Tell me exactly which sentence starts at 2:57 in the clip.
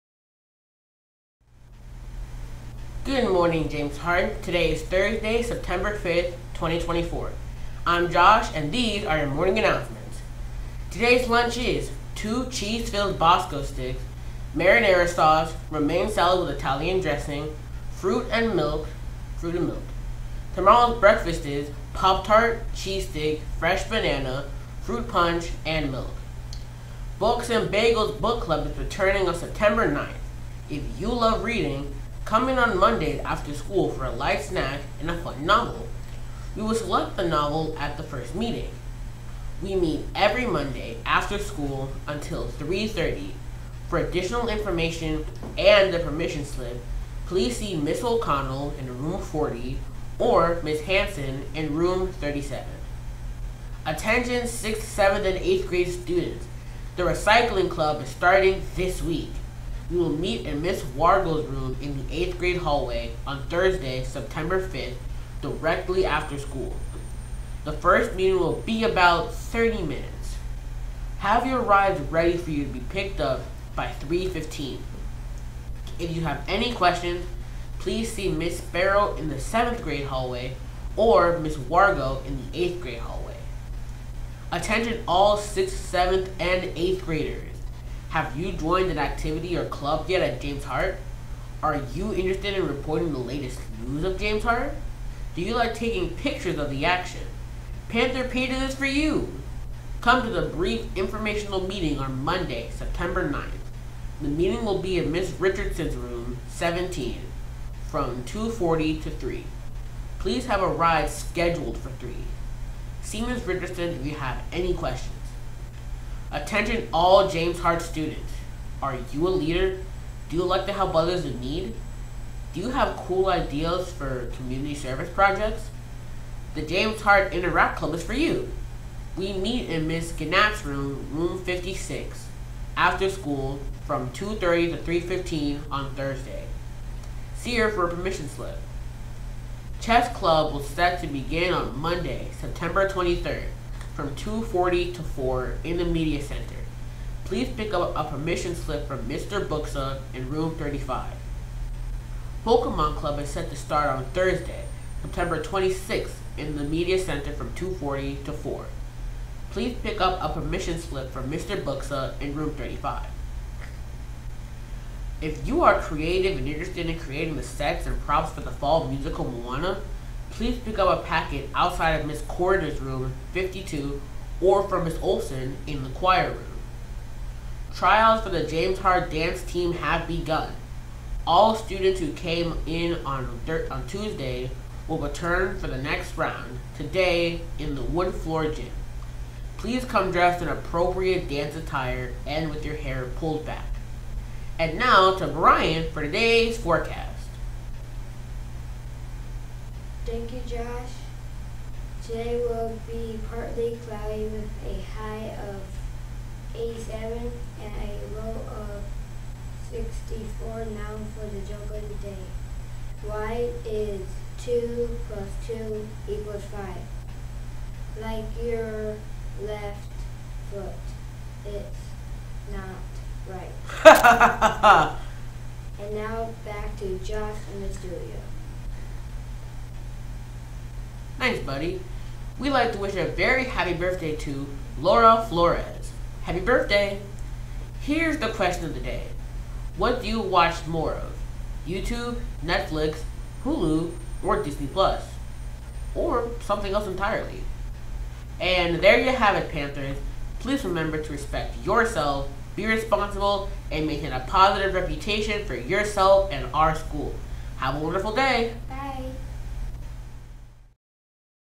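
Tryouts for the James Hart dance team have begun.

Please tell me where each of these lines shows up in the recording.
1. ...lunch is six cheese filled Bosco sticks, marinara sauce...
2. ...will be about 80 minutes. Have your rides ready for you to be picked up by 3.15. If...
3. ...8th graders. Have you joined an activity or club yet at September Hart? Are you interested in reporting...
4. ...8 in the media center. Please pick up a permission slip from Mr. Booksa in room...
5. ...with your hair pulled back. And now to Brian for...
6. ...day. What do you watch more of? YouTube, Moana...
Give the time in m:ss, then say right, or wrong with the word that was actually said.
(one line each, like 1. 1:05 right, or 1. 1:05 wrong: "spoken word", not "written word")
1. 0:11 wrong: "two", not "six"
2. 1:08 wrong: "30", not "80"
3. 1:26 wrong: "James", not "September"
4. 2:25 wrong: "4", not "8"
5. 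3:12 right
6. 3:58 wrong: "Netflix", not "Moana".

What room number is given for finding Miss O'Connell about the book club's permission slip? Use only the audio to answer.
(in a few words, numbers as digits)
40.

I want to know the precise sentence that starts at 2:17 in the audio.
See her for a permission slip.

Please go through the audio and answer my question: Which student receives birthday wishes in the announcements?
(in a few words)
Laura Flores.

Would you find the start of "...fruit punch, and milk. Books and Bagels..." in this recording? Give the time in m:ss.
0:24.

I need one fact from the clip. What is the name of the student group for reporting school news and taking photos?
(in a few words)
Panther Pages.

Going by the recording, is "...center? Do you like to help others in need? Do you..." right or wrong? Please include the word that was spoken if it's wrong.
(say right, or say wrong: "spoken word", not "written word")
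wrong: "leader", not "center".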